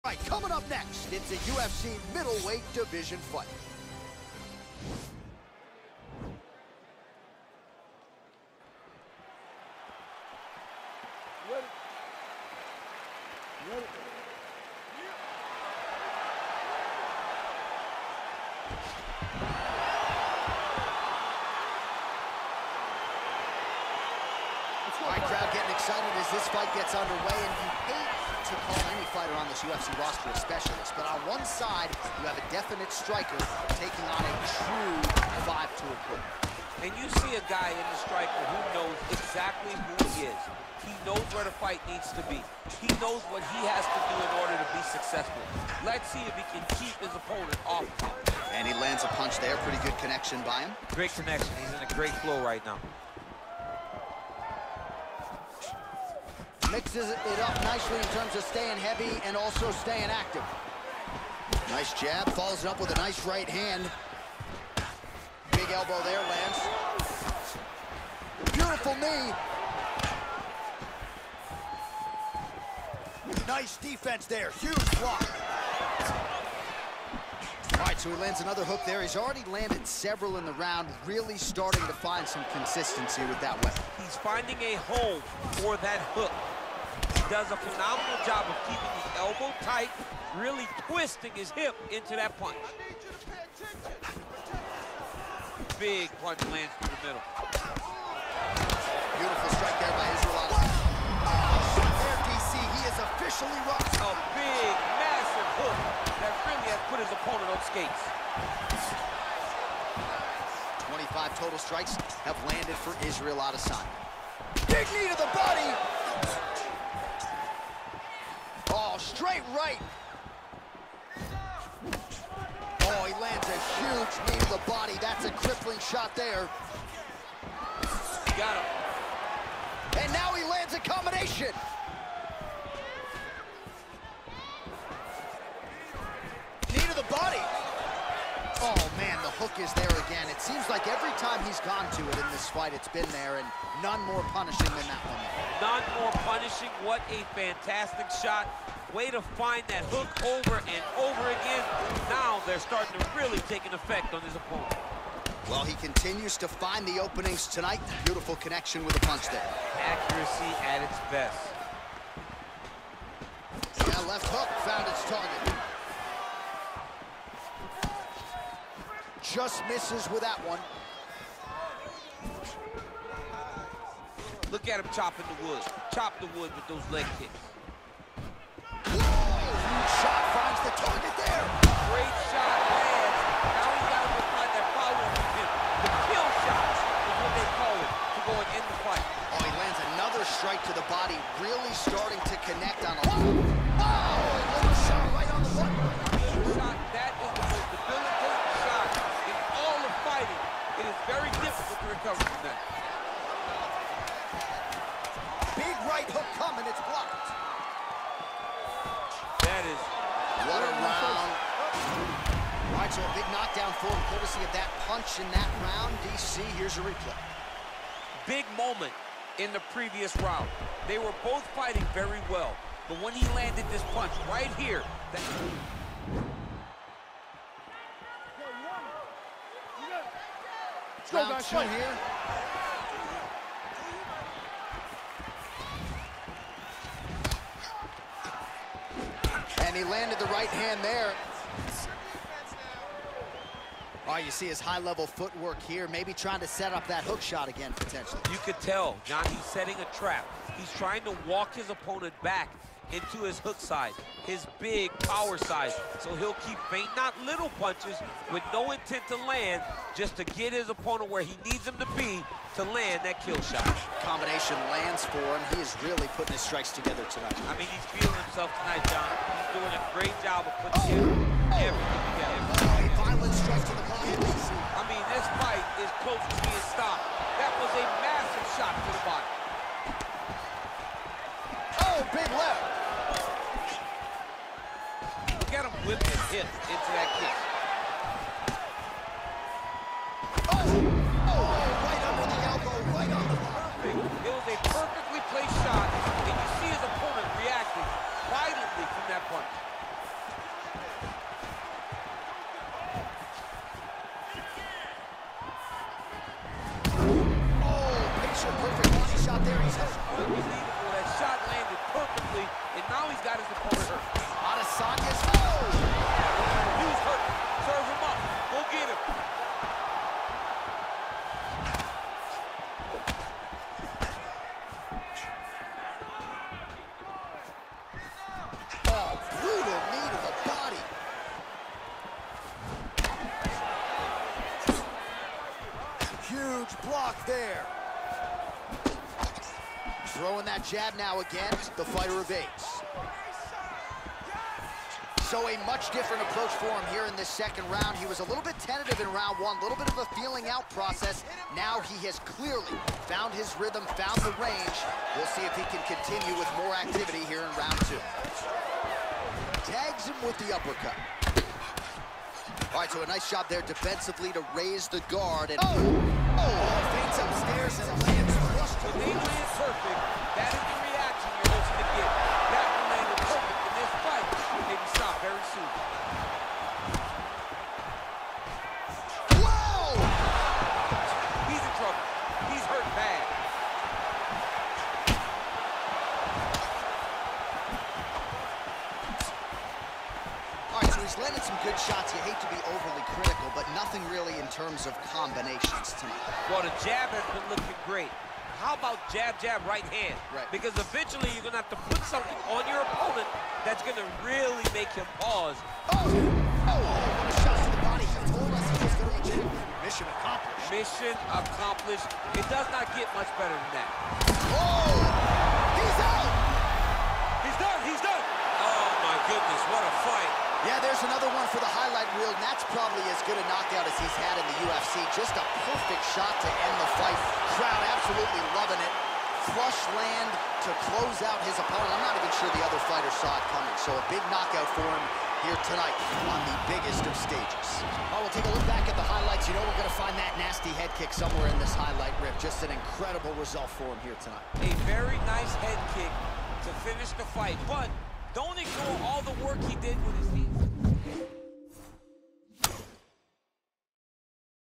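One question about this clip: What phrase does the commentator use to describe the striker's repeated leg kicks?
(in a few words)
Chopping the wood.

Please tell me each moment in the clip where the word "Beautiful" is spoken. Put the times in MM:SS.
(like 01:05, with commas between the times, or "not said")
01:08, 01:39, 02:38.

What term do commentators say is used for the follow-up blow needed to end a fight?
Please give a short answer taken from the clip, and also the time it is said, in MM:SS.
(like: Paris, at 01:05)
The kill shots, at 03:05.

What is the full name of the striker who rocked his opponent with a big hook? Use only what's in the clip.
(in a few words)
Israel Adesanya.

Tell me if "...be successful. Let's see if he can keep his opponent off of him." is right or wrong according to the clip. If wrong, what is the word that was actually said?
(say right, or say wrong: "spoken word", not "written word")
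right.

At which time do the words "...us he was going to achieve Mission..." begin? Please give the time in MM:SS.
06:48.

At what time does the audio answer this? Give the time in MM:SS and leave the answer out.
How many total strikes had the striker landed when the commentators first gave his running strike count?
01:50.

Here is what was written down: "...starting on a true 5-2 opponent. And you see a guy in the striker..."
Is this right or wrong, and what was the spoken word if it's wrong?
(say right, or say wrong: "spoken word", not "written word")
wrong: "taking", not "starting".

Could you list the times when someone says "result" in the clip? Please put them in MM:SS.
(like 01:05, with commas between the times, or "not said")
07:23.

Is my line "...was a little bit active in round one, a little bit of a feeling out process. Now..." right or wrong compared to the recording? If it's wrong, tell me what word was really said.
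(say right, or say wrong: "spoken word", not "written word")
wrong: "tentative", not "active".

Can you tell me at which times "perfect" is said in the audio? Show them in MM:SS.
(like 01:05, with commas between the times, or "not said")
07:05.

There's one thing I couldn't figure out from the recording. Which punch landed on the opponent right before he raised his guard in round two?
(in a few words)
Uppercut.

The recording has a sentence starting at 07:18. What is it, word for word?
All right, we'll take a look back at the highlights.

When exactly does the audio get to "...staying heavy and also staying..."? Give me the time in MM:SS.
00:58.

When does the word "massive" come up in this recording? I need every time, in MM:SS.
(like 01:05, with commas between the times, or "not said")
01:44, 04:38.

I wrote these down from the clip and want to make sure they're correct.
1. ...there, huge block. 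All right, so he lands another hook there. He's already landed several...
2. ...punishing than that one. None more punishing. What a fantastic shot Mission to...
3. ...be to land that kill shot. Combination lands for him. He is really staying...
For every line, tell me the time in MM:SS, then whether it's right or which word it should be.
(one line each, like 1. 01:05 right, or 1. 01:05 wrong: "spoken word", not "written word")
1. 01:14 right
2. 02:24 wrong: "Way", not "Mission"
3. 04:21 wrong: "putting", not "staying".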